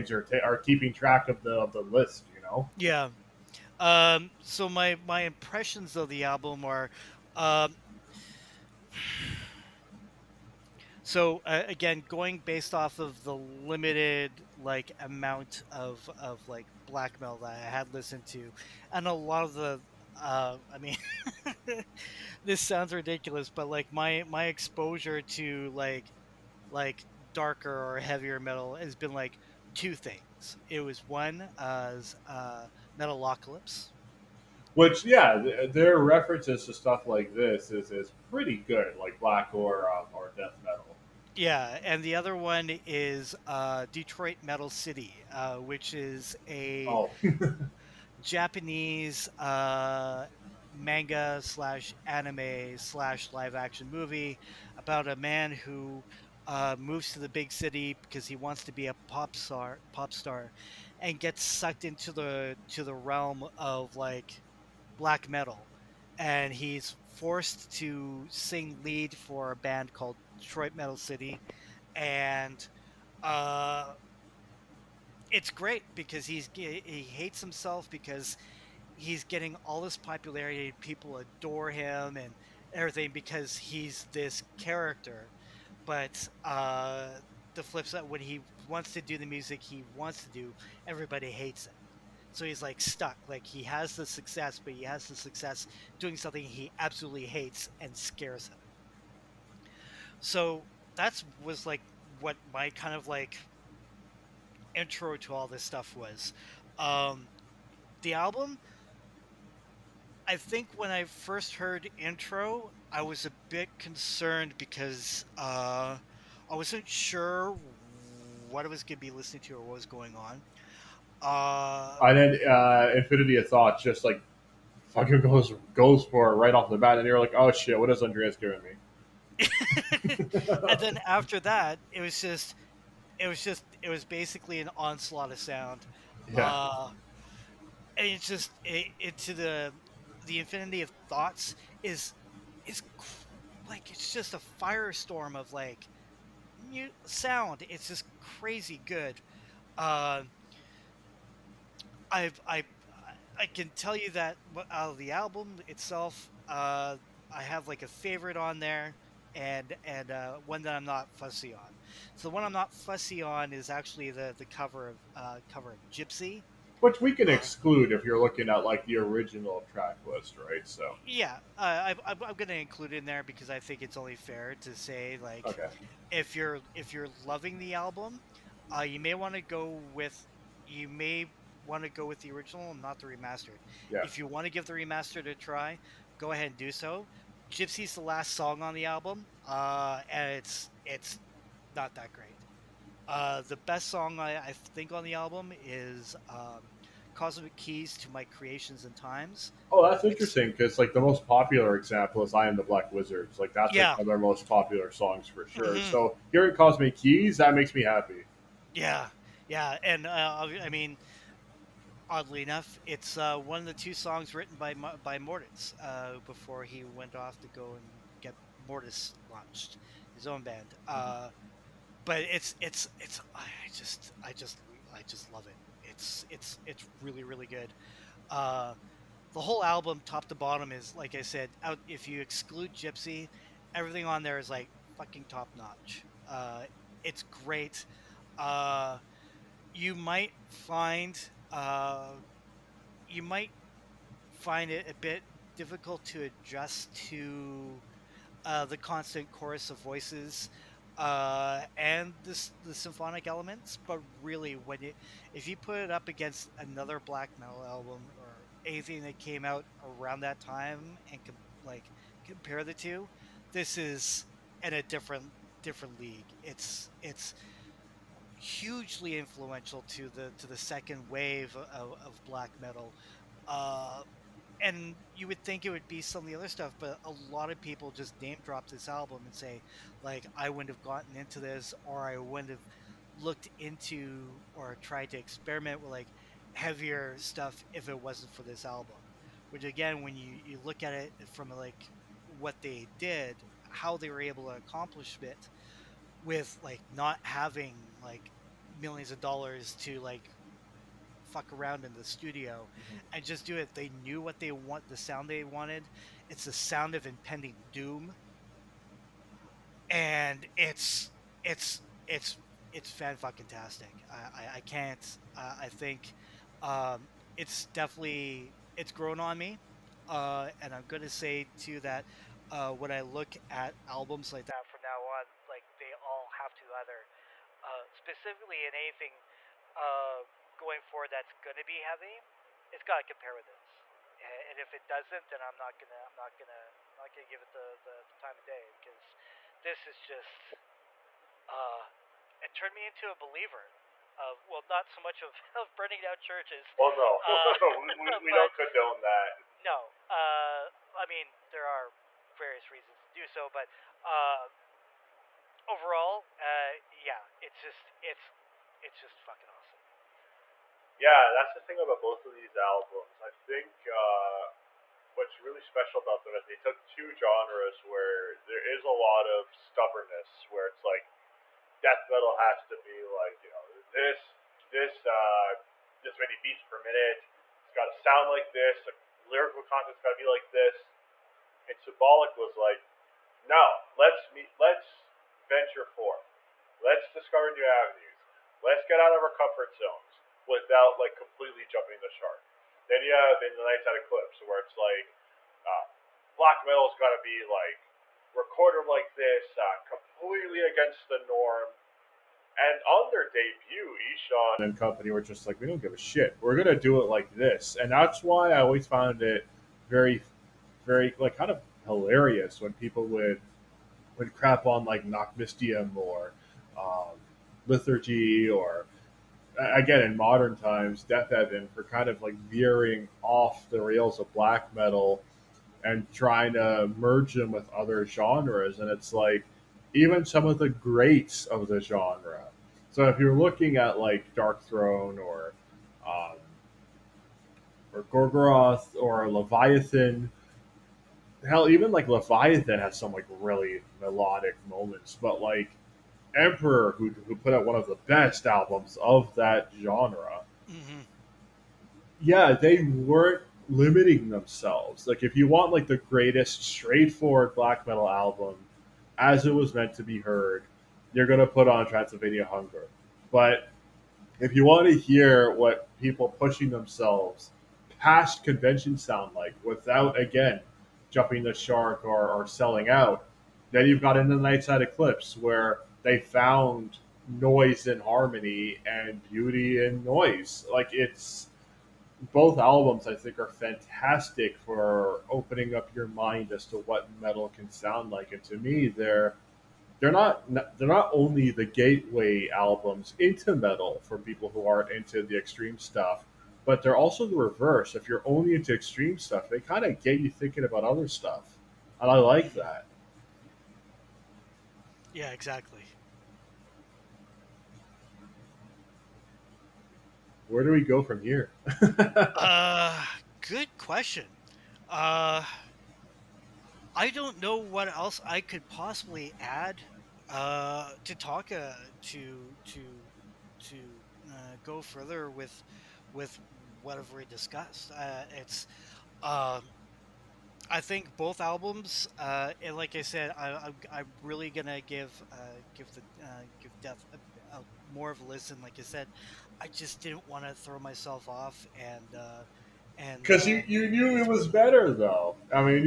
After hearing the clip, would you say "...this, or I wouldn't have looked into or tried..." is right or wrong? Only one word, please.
right.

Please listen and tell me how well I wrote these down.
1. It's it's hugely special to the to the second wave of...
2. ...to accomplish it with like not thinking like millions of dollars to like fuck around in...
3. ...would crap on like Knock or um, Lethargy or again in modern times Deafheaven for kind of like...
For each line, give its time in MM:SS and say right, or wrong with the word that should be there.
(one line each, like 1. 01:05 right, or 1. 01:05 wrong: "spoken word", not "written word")
1. 04:26 wrong: "influential", not "special"
2. 04:54 wrong: "having", not "thinking"
3. 06:54 right.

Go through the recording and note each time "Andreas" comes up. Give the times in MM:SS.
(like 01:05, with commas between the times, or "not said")
02:08.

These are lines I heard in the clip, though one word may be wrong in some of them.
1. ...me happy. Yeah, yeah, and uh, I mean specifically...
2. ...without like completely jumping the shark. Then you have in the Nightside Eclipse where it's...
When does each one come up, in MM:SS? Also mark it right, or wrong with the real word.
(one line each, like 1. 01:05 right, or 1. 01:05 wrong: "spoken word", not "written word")
1. 03:27 wrong: "oddly", not "specifically"
2. 06:30 right.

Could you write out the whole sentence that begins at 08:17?
If you're only into extreme stuff, they kind of get you thinking about other stuff, and I like that.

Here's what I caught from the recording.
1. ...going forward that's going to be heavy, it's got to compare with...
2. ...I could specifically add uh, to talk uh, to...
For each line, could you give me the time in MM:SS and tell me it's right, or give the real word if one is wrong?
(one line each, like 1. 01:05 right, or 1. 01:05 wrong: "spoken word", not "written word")
1. 05:30 right
2. 08:38 wrong: "possibly", not "specifically".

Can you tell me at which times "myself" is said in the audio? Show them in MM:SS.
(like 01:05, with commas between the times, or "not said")
09:00.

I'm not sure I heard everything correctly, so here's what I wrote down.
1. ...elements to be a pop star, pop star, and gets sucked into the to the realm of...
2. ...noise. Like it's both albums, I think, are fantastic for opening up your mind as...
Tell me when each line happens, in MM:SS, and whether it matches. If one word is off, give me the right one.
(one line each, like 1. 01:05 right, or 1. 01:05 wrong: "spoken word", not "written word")
1. 00:58 wrong: "wants", not "elements"
2. 08:00 right.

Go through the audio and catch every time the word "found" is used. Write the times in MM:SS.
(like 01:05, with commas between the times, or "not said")
06:48, 07:56.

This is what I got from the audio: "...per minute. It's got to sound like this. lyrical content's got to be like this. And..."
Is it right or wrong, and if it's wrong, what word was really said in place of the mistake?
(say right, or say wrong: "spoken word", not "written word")
right.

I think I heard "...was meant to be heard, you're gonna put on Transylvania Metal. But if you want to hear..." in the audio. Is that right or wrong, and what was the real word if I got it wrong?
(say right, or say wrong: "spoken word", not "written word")
wrong: "Hunger", not "Metal".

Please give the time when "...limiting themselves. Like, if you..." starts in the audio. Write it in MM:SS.
07:33.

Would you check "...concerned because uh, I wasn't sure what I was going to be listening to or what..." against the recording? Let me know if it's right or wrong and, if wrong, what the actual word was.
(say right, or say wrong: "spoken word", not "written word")
right.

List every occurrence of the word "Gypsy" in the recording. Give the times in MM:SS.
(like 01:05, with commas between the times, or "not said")
02:45, 03:07, 03:52.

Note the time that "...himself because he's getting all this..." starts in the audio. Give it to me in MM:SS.
01:17.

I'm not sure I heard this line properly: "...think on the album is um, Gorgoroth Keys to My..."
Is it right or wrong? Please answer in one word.
wrong.